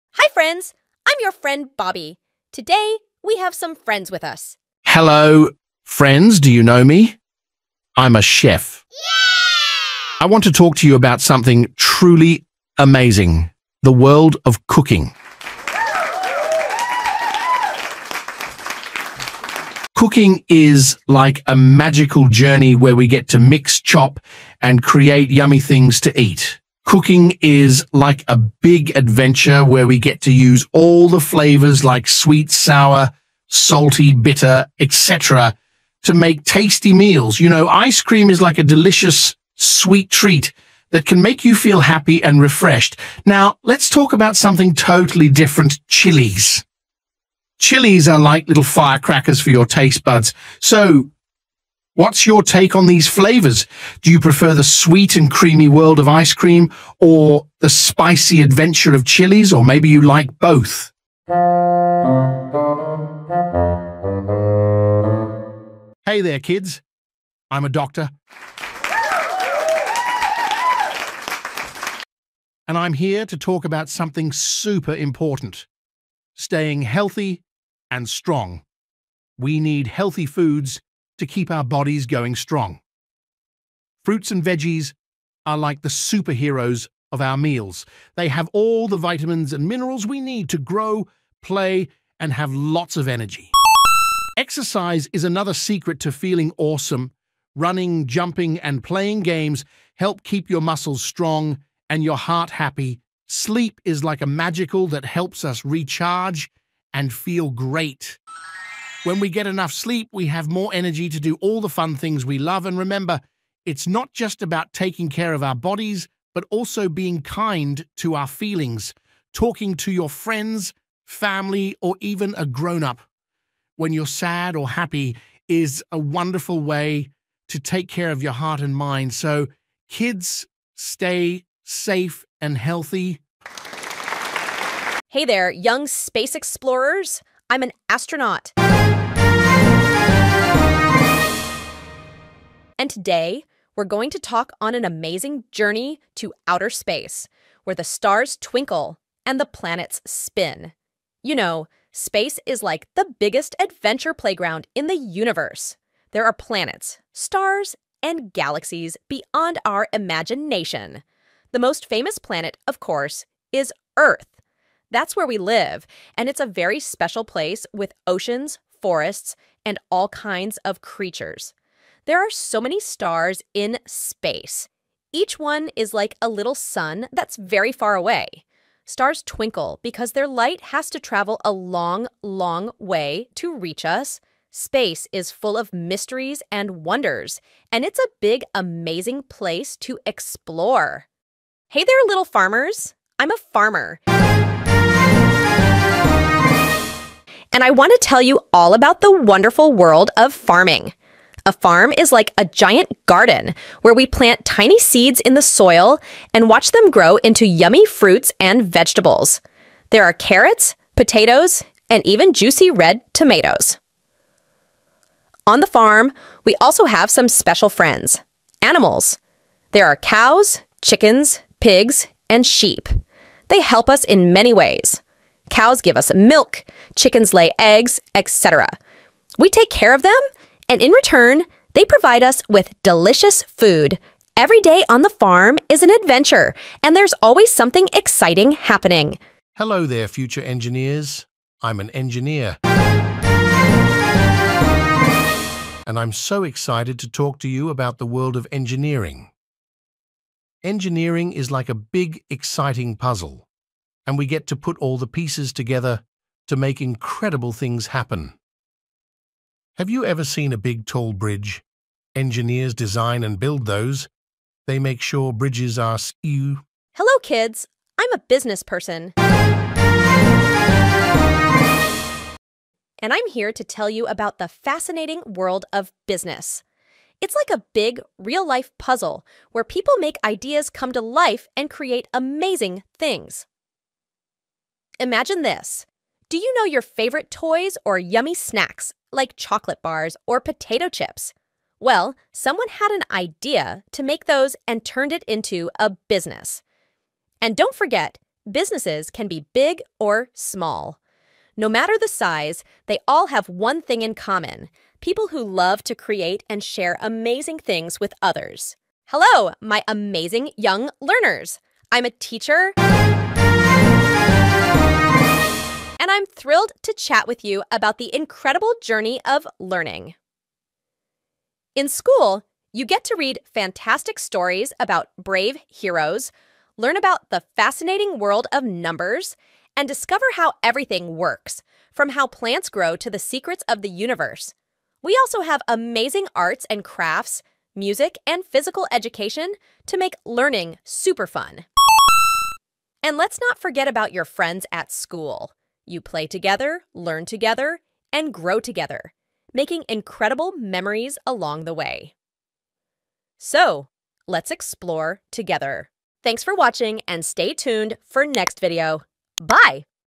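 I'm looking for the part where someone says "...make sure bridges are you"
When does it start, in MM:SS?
04:24.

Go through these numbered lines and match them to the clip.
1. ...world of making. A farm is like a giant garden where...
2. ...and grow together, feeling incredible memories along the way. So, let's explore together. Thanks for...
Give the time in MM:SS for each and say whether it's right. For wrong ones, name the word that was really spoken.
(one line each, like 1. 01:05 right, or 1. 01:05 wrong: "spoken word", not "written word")
1. 03:19 wrong: "farming", not "making"
2. 05:48 wrong: "making", not "feeling".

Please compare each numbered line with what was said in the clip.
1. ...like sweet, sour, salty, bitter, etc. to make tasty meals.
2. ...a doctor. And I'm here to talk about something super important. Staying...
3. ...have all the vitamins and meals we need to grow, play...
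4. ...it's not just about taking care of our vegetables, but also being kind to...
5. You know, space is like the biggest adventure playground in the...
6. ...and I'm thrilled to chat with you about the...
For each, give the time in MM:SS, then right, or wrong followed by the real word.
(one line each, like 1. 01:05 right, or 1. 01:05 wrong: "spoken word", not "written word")
1. 00:31 right
2. 01:07 right
3. 01:28 wrong: "minerals", not "meals"
4. 01:53 wrong: "bodies", not "vegetables"
5. 02:31 right
6. 05:16 right.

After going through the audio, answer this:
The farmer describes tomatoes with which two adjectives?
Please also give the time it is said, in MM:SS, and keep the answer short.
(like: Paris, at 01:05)
Juicy red, at 03:32.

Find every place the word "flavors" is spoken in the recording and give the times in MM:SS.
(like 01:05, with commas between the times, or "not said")
00:31, 00:53.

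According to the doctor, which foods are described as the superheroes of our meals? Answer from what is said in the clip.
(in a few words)
Fruits and veggies.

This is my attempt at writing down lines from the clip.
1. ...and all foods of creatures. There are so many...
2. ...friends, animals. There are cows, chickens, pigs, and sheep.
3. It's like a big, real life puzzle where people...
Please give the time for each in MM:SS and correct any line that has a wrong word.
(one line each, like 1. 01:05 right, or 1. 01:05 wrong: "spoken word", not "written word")
1. 02:49 wrong: "kinds", not "foods"
2. 03:37 right
3. 04:37 right.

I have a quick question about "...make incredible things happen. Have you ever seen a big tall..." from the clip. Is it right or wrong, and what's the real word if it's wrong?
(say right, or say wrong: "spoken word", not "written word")
right.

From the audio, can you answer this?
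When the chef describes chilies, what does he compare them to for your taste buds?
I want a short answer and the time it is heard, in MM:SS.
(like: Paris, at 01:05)
Little firecrackers, at 00:48.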